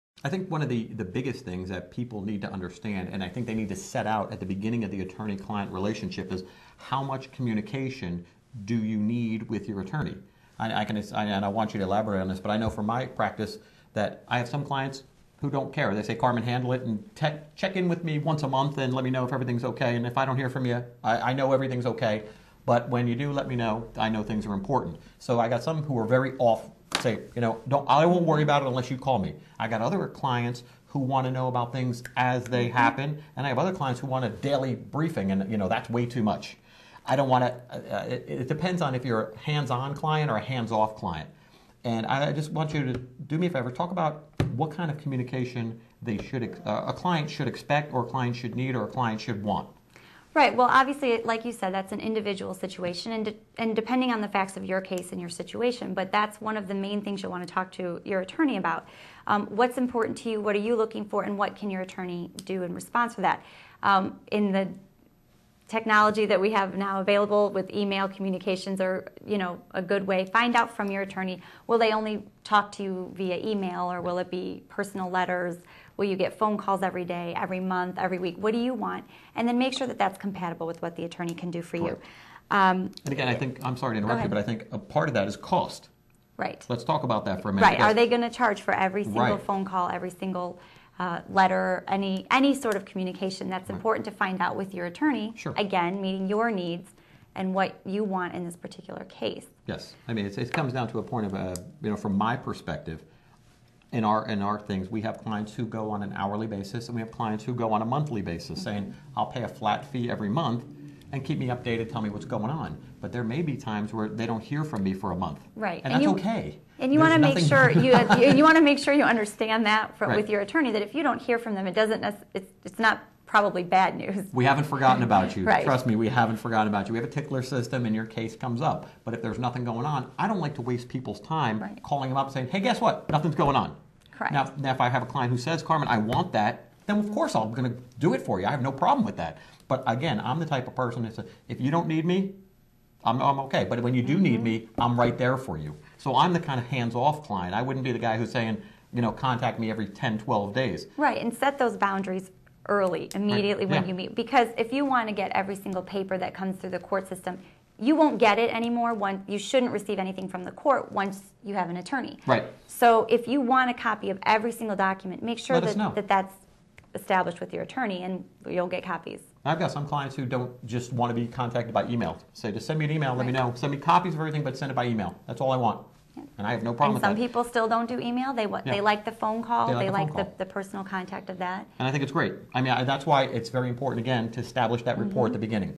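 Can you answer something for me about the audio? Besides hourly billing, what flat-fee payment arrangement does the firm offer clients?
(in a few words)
Monthly basis.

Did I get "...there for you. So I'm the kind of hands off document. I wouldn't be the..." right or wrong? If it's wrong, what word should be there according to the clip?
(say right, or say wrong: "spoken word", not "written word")
wrong: "client", not "document".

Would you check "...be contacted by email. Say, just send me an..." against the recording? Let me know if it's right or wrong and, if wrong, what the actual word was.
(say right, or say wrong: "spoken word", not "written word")
right.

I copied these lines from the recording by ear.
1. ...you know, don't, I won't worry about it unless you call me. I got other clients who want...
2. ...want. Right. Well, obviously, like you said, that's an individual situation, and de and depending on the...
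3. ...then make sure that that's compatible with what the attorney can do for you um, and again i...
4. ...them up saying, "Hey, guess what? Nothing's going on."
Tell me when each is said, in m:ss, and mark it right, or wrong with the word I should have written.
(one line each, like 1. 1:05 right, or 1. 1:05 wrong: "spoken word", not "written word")
1. 0:27 right
2. 0:49 right
3. 1:19 right
4. 2:12 right.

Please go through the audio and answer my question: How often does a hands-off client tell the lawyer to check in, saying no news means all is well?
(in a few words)
Once a month.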